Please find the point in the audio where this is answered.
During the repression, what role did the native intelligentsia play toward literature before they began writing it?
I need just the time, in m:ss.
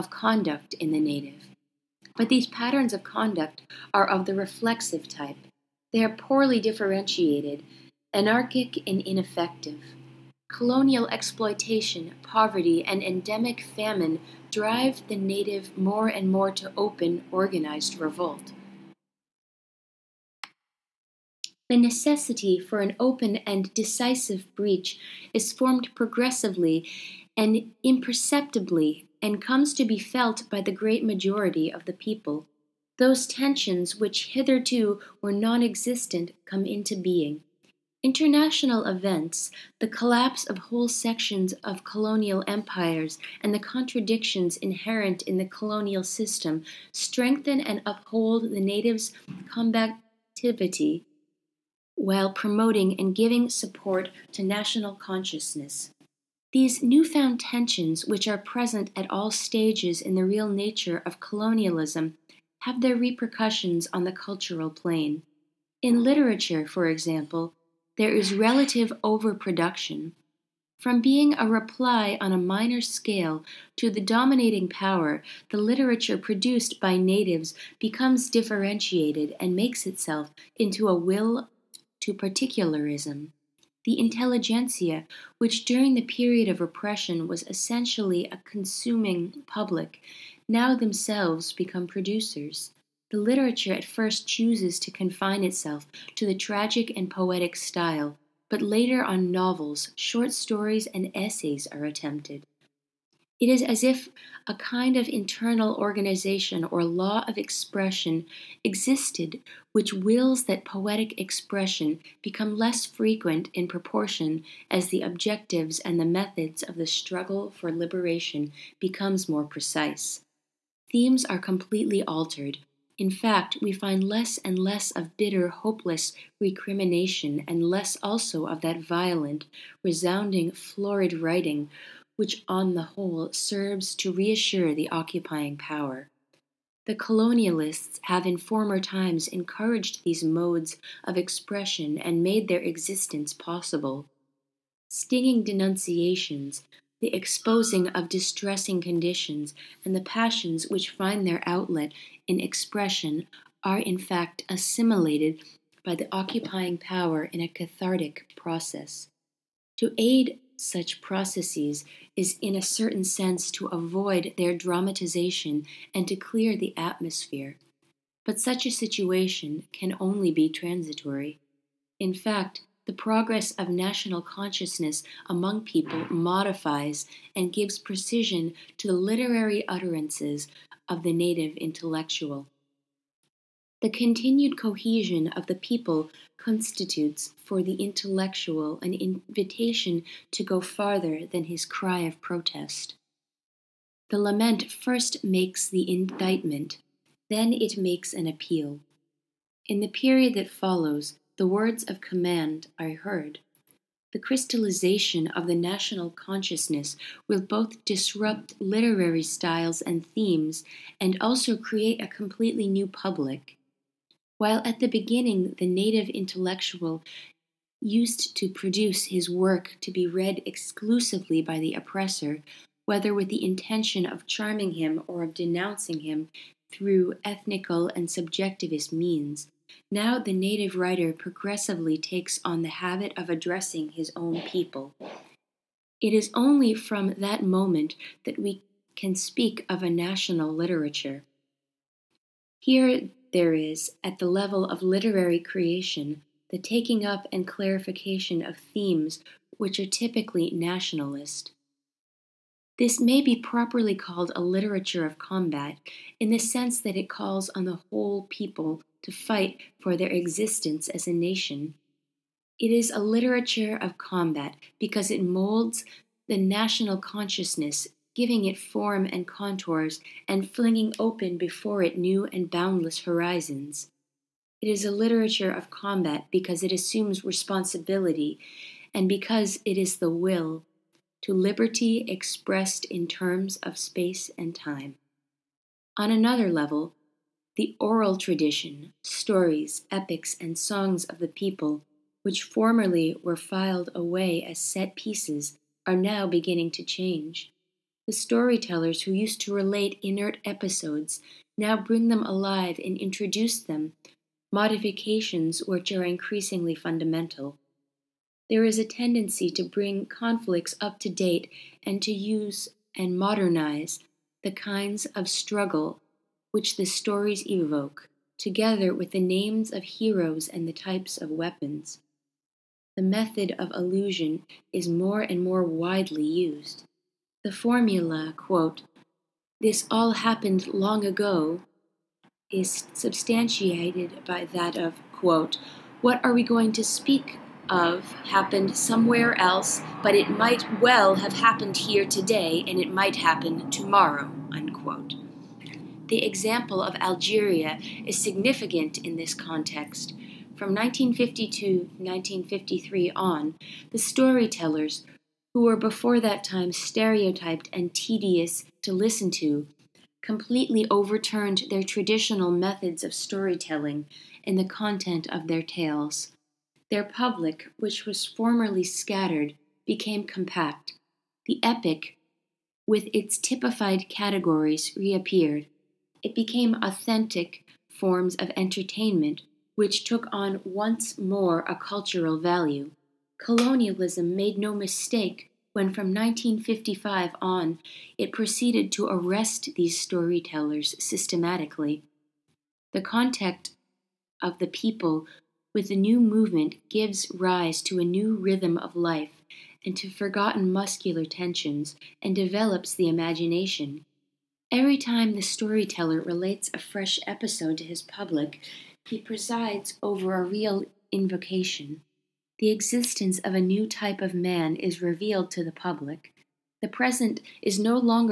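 1:28.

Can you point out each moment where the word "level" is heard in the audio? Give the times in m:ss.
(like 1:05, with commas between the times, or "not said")
4:04, 4:46.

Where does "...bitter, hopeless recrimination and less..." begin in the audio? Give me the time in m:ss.
2:05.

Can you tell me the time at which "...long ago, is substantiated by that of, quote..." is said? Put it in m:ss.
5:30.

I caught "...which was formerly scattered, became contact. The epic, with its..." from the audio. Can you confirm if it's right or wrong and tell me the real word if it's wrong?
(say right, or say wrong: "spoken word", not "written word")
wrong: "compact", not "contact".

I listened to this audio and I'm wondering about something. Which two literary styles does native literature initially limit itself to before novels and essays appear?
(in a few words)
tragic and poetic.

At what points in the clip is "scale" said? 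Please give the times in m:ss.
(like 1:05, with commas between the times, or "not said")
1:12.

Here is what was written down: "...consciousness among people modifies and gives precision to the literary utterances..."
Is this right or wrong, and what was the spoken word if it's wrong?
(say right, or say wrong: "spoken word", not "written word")
right.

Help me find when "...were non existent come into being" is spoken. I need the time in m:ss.
0:35.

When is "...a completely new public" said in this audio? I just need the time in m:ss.
3:32.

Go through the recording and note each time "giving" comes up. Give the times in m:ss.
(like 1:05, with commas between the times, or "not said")
0:53, 4:28.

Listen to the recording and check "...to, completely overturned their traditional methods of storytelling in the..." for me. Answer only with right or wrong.
right.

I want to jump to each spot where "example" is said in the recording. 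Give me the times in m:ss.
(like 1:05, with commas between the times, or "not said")
1:06, 5:46.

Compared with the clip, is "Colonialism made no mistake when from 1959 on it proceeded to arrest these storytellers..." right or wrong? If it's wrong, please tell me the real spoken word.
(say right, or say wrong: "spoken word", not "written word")
wrong: "1955", not "1959".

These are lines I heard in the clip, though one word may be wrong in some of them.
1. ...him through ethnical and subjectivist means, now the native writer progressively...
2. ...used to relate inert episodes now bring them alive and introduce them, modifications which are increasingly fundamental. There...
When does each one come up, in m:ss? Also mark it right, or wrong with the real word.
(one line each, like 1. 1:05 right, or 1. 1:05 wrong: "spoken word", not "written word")
1. 3:46 right
2. 4:59 right.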